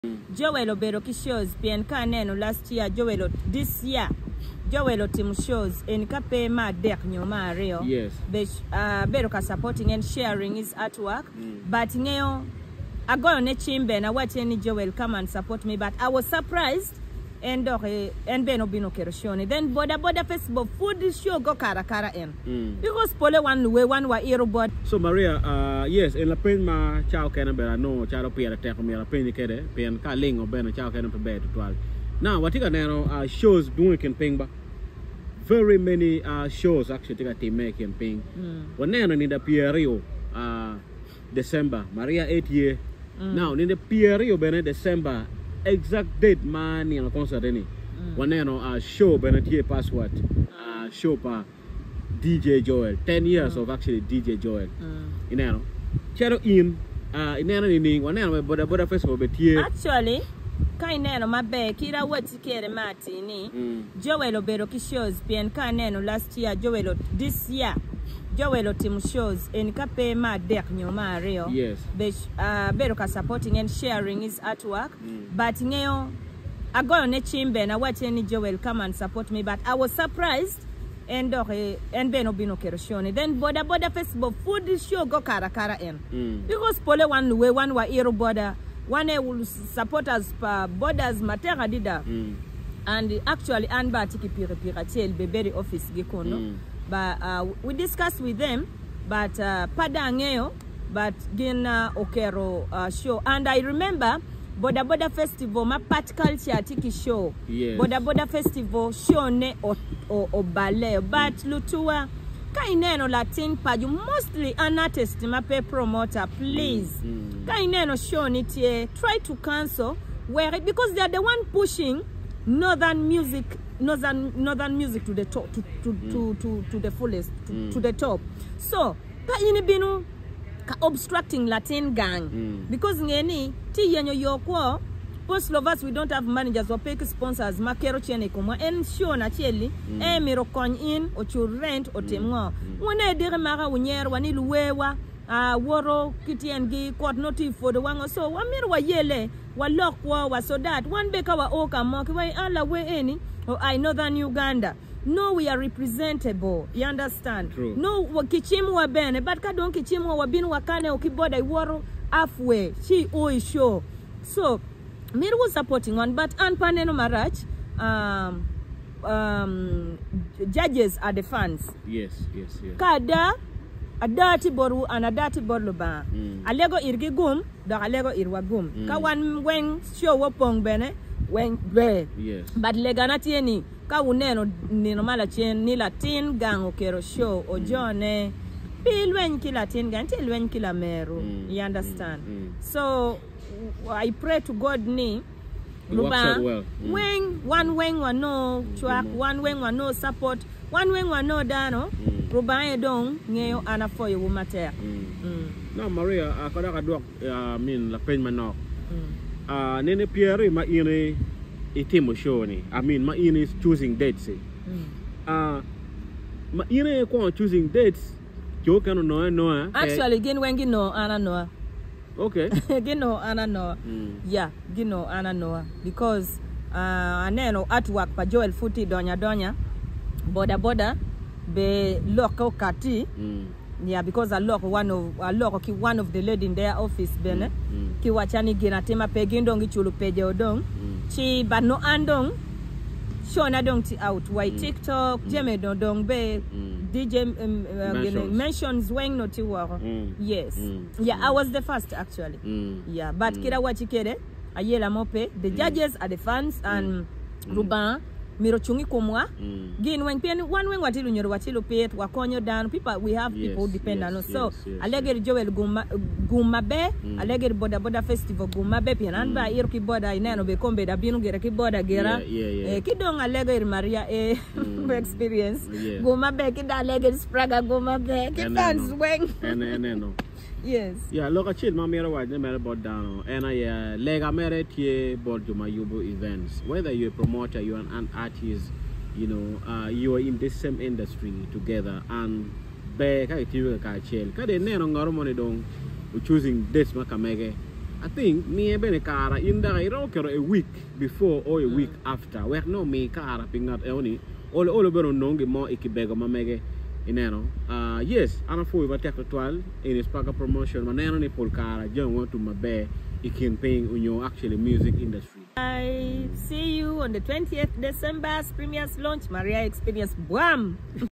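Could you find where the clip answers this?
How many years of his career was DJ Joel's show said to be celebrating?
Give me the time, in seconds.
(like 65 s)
53 s.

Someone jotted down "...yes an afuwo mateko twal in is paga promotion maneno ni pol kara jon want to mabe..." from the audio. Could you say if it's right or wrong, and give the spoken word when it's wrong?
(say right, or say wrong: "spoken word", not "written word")
right.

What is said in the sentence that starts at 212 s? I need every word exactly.
I mean ma ine is choosing dates.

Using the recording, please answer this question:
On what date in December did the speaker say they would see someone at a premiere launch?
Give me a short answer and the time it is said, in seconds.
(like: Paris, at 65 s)
20th December, at 317 s.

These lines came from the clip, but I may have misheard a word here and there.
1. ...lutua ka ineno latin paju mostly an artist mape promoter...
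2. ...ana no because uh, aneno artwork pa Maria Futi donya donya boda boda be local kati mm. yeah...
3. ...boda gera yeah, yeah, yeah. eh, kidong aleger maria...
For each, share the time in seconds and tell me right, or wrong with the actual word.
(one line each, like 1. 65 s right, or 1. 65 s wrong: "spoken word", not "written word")
1. 111 s right
2. 225 s wrong: "Joel", not "Maria"
3. 271 s right.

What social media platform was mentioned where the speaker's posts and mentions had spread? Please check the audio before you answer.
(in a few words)
TikTok.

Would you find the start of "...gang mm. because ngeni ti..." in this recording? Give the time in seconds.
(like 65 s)
131 s.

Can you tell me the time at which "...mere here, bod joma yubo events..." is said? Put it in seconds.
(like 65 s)
284 s.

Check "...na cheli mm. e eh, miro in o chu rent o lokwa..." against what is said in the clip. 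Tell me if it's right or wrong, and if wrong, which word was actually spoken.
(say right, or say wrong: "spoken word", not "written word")
wrong: "temwa", not "lokwa".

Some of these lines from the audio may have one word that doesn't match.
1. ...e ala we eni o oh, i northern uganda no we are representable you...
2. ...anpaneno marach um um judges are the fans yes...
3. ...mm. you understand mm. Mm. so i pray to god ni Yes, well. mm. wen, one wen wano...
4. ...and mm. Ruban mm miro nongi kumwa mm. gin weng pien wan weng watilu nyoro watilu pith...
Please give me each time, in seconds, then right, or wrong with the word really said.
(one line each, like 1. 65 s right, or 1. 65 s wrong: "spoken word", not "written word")
1. 152 s right
2. 166 s right
3. 191 s wrong: "Luba", not "Yes"
4. 256 s wrong: "chungi", not "nongi".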